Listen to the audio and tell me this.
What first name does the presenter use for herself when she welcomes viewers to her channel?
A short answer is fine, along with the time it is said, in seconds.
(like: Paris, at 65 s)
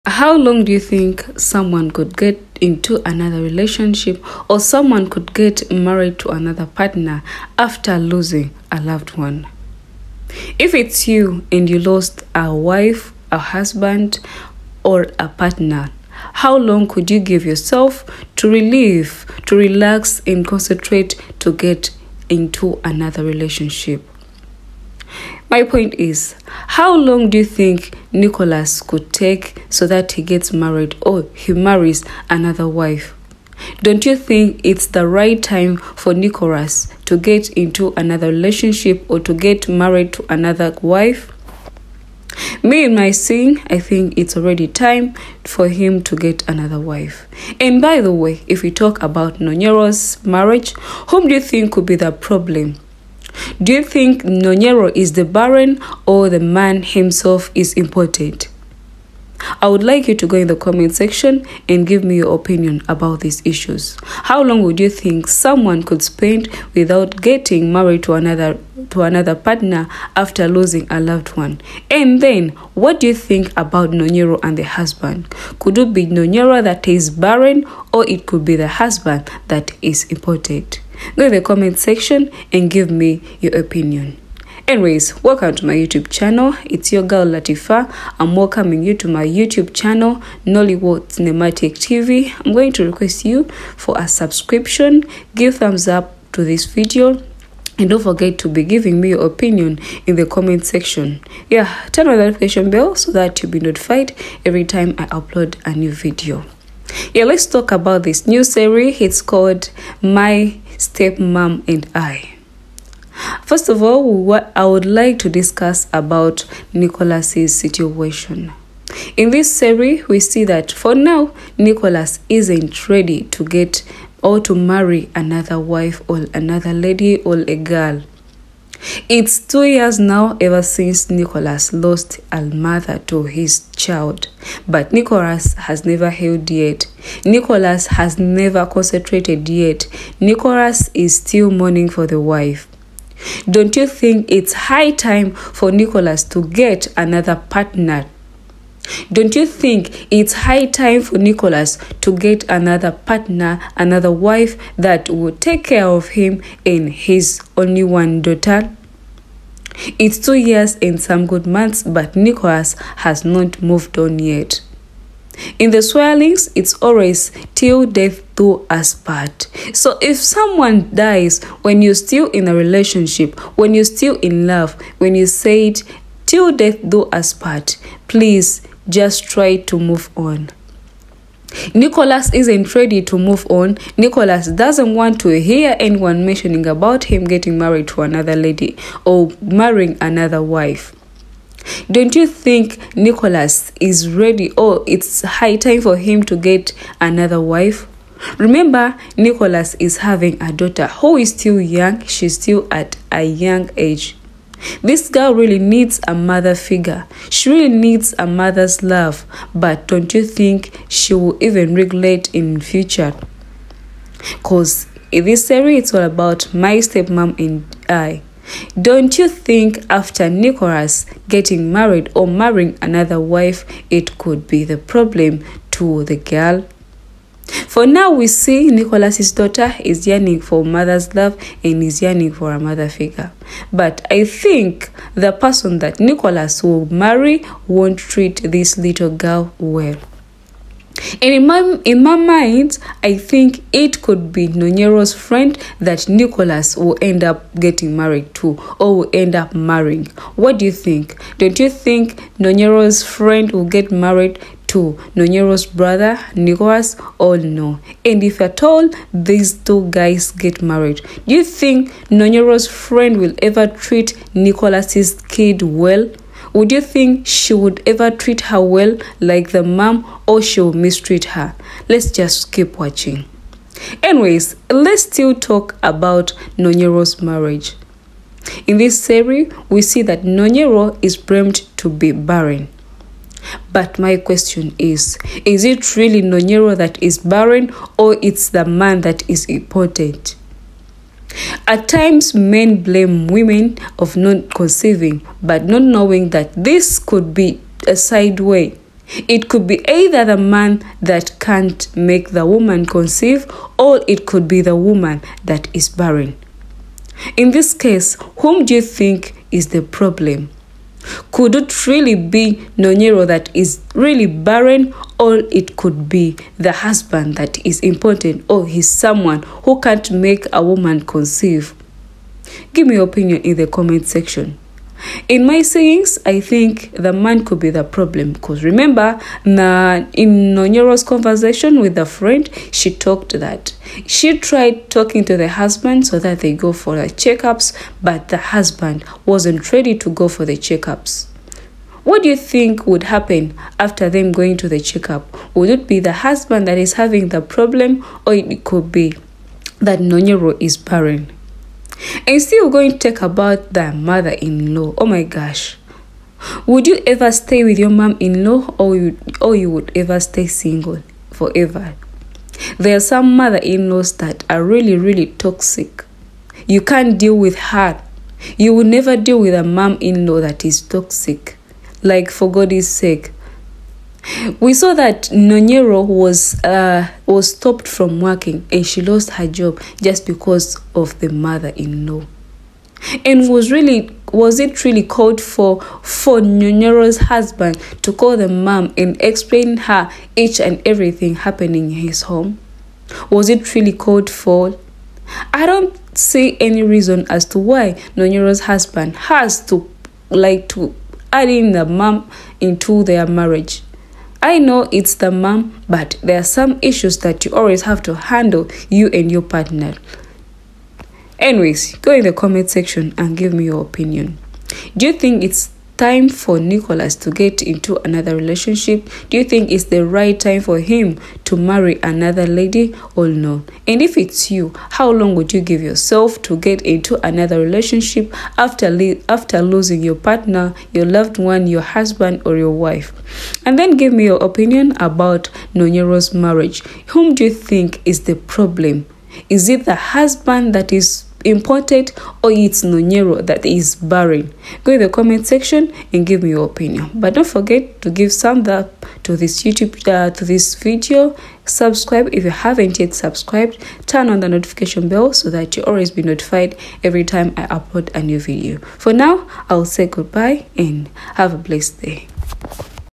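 Latifa, at 87 s.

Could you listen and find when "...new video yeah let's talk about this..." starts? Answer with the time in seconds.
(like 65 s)
105 s.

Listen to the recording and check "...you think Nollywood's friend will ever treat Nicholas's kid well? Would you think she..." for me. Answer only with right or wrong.
wrong.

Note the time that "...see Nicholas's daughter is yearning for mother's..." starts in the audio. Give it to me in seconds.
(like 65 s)
228 s.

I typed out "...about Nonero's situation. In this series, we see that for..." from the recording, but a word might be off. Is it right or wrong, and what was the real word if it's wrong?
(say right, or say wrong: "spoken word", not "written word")
wrong: "Nicholas", not "Nonero".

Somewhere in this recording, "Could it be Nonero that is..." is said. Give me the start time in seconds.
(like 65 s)
75 s.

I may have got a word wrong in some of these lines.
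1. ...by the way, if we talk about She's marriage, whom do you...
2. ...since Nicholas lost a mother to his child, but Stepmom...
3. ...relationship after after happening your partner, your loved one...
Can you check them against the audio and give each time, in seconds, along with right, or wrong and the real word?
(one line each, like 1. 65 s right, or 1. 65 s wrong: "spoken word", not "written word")
1. 47 s wrong: "Nonero", not "She"
2. 130 s wrong: "Nicholas", not "Stepmom"
3. 427 s wrong: "losing", not "happening".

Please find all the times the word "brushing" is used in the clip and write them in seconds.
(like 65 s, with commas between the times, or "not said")
not said.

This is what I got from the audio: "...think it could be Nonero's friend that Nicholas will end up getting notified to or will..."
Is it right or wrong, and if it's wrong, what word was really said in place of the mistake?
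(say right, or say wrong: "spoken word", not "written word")
wrong: "married", not "notified".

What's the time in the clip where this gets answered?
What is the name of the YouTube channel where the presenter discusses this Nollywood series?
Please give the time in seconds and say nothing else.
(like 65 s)
90 s.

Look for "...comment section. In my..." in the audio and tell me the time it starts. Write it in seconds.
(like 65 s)
323 s.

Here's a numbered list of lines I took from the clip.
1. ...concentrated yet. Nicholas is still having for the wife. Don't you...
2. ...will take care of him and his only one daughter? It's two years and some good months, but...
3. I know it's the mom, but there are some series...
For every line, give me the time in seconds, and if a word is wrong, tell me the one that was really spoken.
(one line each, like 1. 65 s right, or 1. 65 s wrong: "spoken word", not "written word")
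1. 138 s wrong: "mourning", not "having"
2. 155 s right
3. 404 s wrong: "issues", not "series".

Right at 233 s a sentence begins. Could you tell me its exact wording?
But I think the person that Nicholas will marry won't treat this little girl well.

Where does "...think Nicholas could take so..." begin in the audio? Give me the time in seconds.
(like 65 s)
27 s.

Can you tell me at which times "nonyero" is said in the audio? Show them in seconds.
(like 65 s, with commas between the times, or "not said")
280 s, 286 s, 312 s, 330 s, 349 s, 398 s, 435 s, 442 s.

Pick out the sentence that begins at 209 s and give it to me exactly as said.
But don't you think she will even regulate in future?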